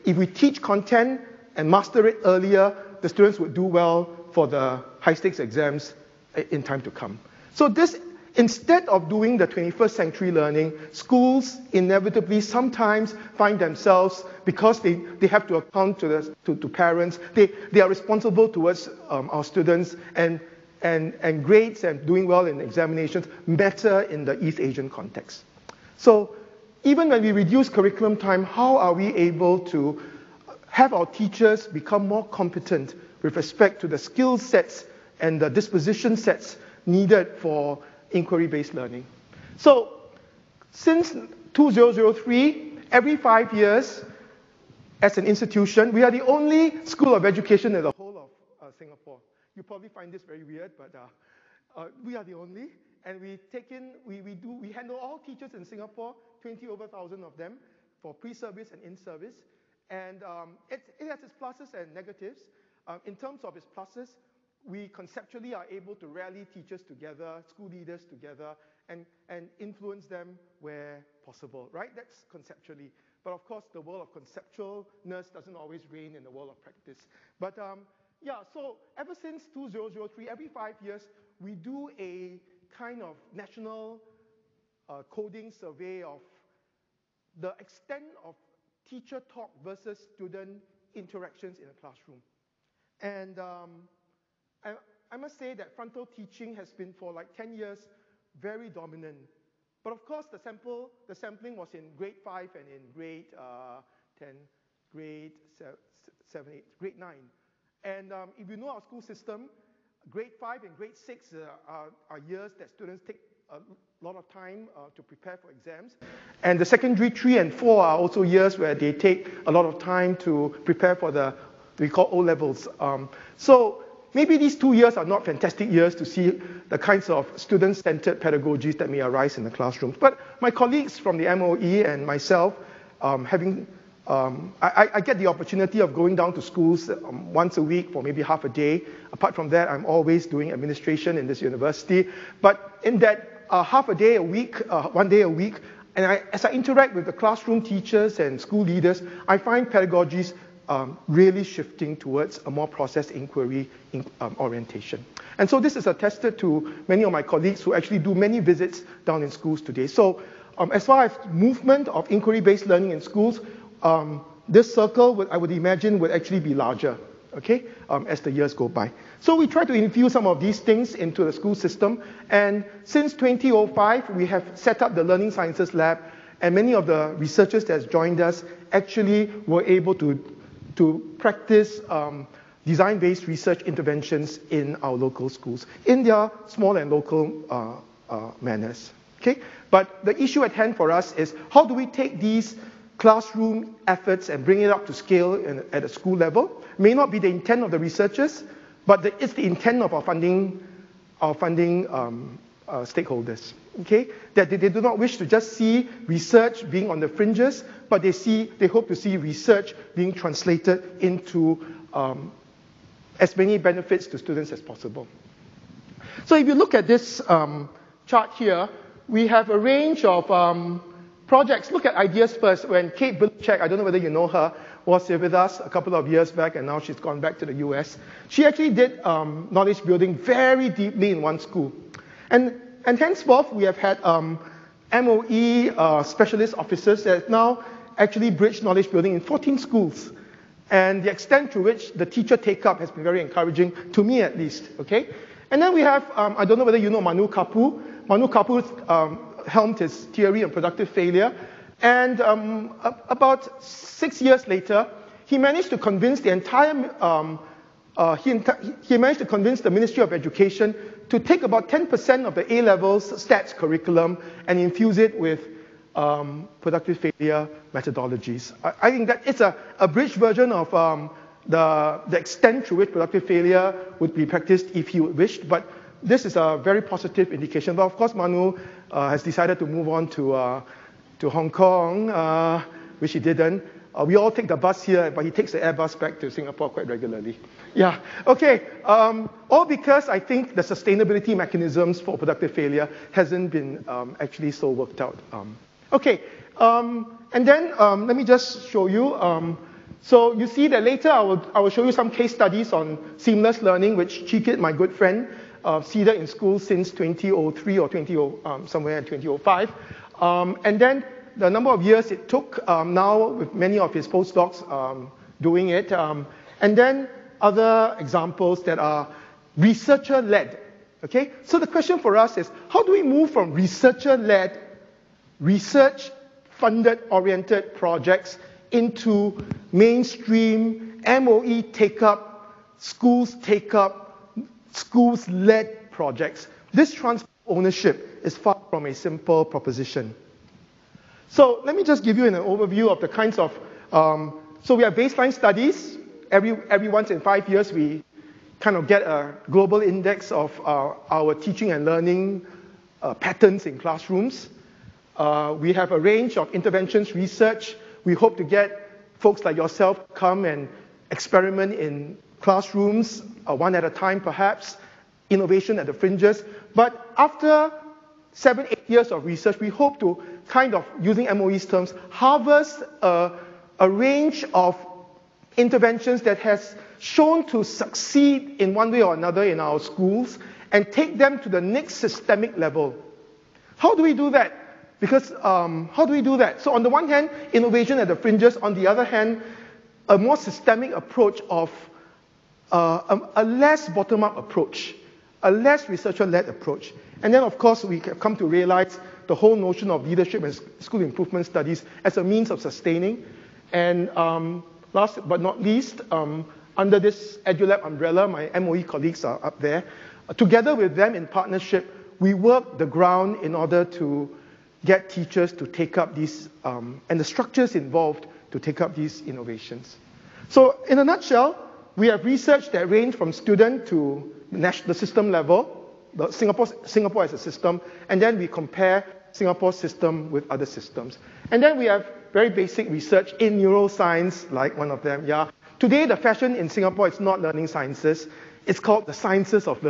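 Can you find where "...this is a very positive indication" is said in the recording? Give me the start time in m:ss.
4:36.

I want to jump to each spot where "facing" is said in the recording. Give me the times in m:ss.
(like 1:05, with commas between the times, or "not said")
not said.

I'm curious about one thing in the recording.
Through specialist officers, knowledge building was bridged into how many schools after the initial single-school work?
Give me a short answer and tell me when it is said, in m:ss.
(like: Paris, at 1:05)
14, at 3:59.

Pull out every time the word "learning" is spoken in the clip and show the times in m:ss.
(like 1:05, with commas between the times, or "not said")
0:10, 0:38, 2:42, 2:55, 5:03, 5:51, 7:17.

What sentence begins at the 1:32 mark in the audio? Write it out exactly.
And um, I, I must say that frontal teaching has been for like 10 years very dominant.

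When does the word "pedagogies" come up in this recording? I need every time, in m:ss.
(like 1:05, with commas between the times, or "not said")
2:08, 2:29.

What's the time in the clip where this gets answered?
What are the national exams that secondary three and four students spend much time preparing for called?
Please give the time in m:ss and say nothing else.
2:02.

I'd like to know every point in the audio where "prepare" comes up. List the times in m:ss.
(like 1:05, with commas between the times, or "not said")
1:55, 2:00.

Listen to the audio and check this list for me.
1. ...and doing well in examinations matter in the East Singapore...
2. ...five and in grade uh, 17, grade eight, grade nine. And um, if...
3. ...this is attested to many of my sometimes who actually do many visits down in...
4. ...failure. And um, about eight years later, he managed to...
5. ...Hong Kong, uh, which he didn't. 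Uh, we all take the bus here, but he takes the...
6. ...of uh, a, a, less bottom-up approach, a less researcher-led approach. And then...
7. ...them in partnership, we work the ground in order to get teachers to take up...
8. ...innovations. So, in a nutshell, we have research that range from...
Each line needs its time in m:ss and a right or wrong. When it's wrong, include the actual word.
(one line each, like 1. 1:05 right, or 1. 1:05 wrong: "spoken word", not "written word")
1. 0:21 wrong: "Asian", not "Singapore"
2. 1:42 wrong: "10", not "17"
3. 2:35 wrong: "colleagues", not "sometimes"
4. 4:10 wrong: "six", not "eight"
5. 4:41 right
6. 6:31 right
7. 6:50 right
8. 6:59 right.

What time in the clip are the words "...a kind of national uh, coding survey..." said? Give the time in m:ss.
1:21.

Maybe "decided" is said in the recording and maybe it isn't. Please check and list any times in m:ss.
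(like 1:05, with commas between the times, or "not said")
4:39.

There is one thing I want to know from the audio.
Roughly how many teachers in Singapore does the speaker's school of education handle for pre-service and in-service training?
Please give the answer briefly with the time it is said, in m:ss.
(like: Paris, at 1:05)
over 1,000, at 0:56.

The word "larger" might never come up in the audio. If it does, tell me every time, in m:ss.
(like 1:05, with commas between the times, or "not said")
2:46.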